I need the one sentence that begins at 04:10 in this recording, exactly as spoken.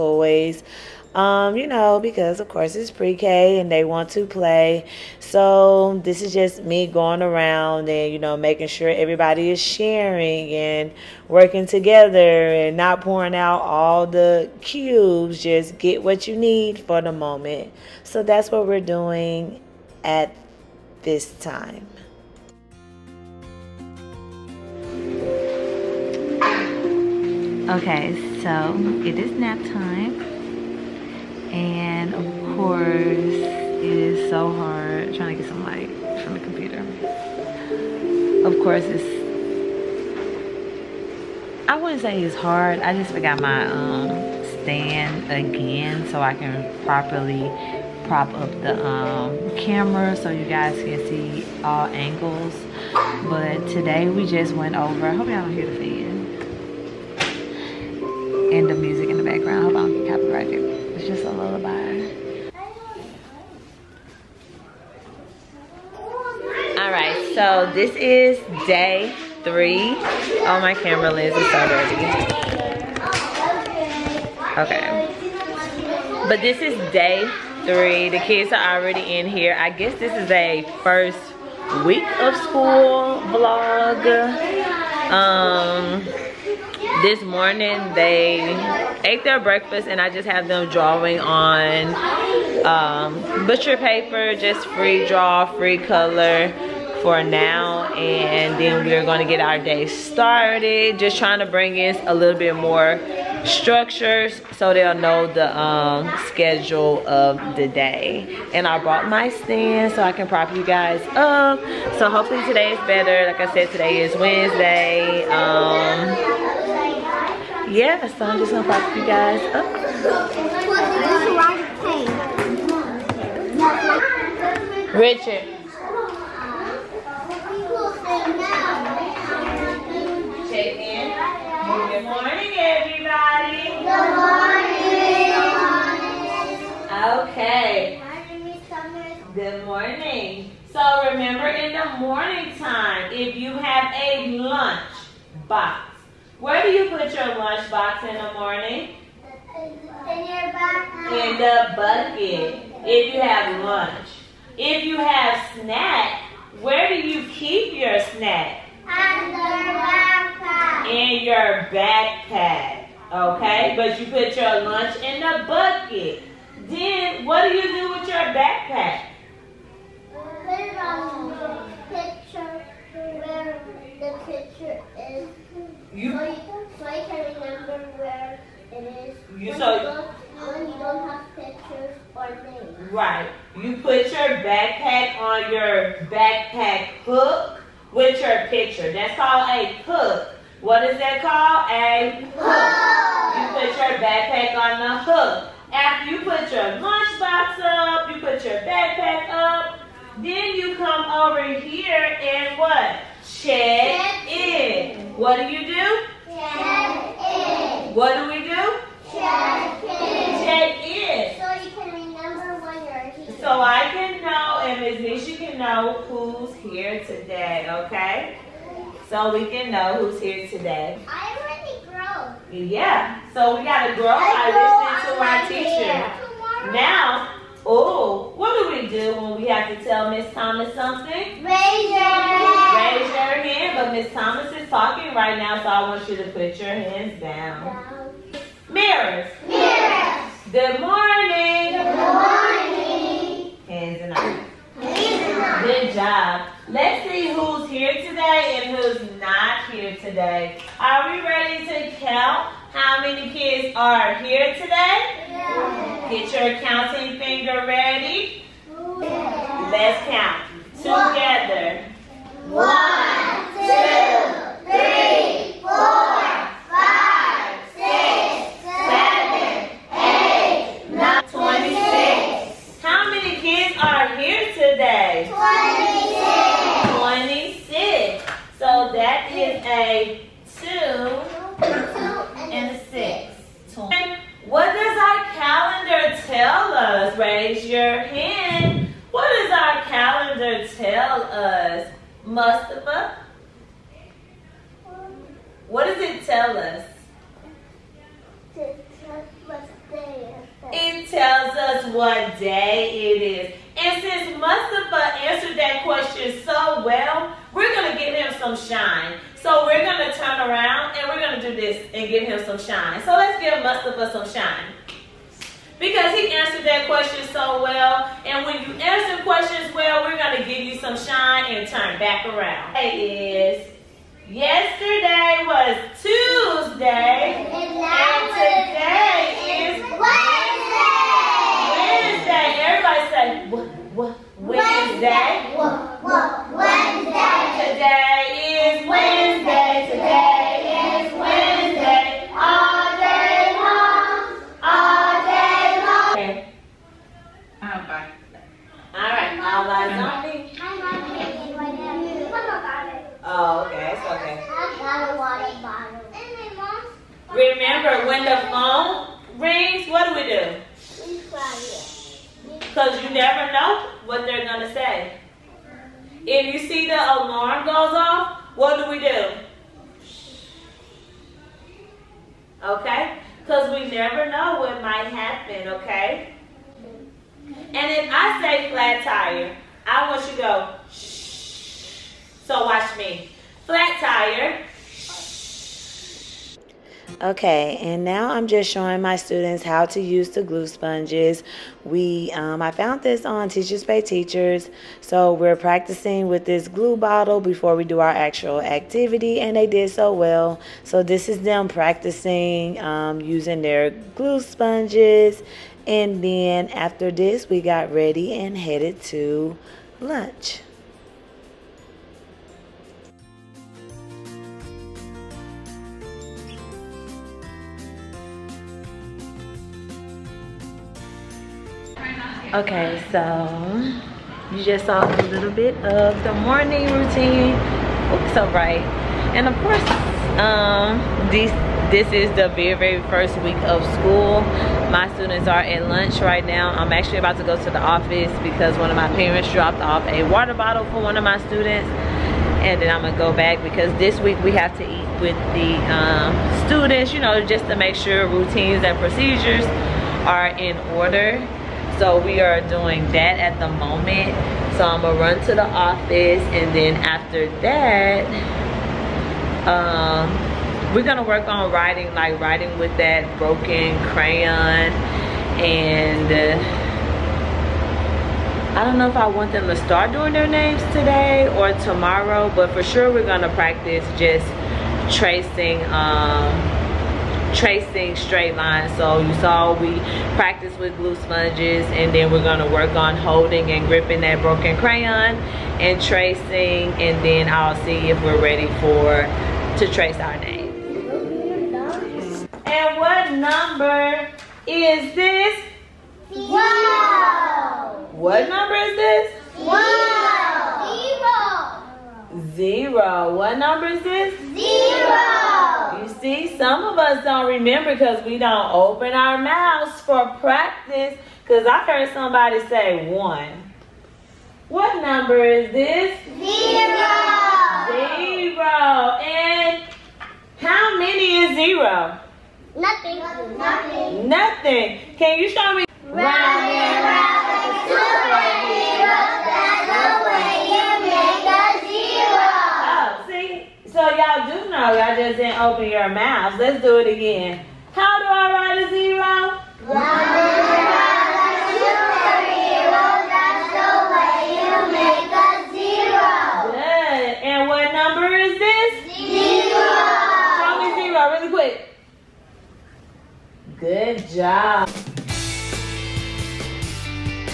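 Are we ready to count how many kids are here today?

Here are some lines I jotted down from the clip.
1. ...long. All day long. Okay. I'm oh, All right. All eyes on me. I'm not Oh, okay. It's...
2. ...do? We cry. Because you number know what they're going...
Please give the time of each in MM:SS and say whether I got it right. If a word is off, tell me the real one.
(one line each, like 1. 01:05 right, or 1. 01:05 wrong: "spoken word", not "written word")
1. 05:43 right
2. 06:00 wrong: "never", not "number".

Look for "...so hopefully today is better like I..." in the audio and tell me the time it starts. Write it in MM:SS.
01:51.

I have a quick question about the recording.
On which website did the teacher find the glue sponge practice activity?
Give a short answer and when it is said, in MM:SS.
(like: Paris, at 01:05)
Teachers Pay Teachers, at 06:33.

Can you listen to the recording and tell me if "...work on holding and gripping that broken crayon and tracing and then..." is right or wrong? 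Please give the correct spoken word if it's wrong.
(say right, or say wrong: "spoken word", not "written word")
right.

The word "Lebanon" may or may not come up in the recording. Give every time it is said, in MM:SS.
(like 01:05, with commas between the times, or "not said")
not said.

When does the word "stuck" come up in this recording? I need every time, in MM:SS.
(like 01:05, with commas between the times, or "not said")
not said.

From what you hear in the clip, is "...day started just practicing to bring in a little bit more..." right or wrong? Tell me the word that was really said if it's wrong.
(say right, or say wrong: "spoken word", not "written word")
wrong: "trying", not "practicing".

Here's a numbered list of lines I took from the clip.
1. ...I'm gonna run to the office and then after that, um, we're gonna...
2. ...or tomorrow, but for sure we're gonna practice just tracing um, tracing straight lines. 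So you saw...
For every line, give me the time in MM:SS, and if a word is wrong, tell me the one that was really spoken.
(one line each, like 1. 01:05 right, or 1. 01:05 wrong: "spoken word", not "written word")
1. 07:34 right
2. 07:51 right.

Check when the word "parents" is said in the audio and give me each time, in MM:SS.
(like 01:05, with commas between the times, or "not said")
07:19.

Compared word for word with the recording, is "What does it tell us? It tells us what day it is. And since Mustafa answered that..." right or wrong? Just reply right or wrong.
right.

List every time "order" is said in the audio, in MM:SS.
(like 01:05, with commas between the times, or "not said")
07:30.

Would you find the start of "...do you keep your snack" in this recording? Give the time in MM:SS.
02:36.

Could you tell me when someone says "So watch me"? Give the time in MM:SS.
06:22.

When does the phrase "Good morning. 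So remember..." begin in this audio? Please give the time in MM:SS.
02:19.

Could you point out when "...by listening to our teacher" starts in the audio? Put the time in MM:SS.
03:45.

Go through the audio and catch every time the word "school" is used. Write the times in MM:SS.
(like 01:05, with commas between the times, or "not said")
01:22, 07:13.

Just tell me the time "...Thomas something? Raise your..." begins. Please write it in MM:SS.
03:50.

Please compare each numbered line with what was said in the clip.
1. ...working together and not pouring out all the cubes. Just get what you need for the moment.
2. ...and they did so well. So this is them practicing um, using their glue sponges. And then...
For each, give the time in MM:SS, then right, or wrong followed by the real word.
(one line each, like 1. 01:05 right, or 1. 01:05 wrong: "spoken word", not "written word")
1. 00:11 right
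2. 06:39 right.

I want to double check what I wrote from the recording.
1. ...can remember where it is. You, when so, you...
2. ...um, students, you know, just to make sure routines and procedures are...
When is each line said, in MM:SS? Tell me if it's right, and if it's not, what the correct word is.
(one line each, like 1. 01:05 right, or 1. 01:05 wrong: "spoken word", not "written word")
1. 02:56 right
2. 07:25 right.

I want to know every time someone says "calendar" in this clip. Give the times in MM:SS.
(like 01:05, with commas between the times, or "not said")
04:45, 04:49.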